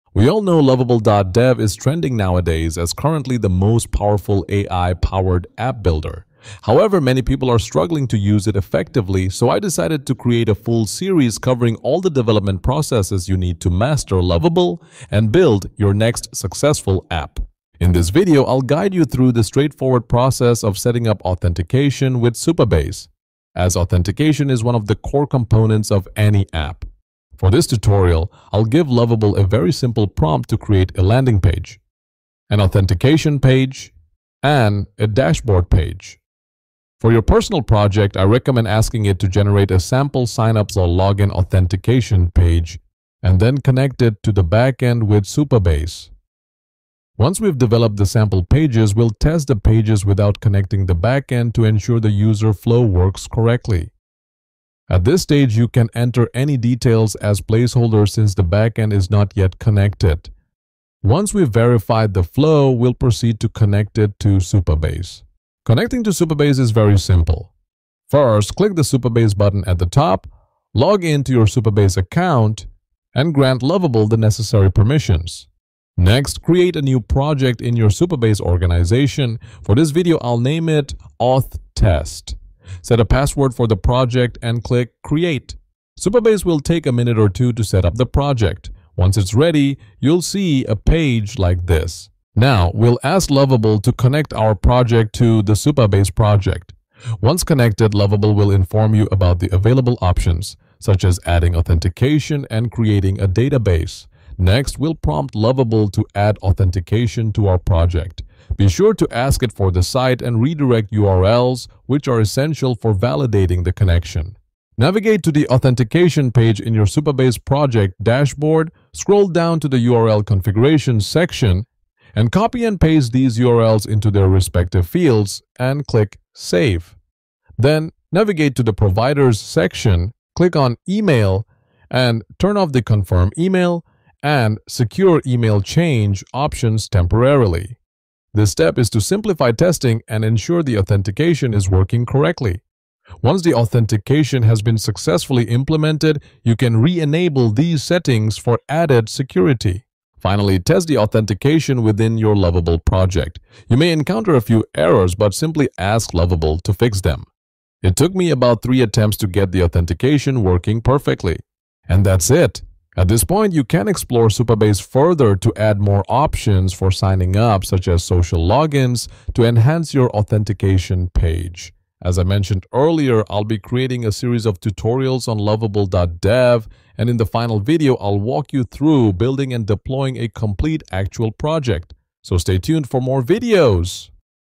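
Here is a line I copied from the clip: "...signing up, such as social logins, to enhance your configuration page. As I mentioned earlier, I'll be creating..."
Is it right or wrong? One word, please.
wrong.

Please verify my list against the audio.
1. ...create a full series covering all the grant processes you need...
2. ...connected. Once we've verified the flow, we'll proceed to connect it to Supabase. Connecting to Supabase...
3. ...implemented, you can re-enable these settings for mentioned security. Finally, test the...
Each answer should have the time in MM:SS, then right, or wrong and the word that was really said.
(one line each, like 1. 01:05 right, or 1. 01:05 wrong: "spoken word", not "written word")
1. 00:10 wrong: "development", not "grant"
2. 00:59 right
3. 02:25 wrong: "added", not "mentioned".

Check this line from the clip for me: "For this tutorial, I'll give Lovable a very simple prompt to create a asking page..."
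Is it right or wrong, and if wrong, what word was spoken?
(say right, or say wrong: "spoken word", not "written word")
wrong: "landing", not "asking".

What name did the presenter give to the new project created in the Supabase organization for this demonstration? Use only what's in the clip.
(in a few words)
Auth Test.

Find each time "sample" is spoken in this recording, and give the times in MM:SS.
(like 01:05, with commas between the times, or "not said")
00:39, 00:48.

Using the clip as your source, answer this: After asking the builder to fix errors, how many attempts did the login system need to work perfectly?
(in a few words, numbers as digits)
3.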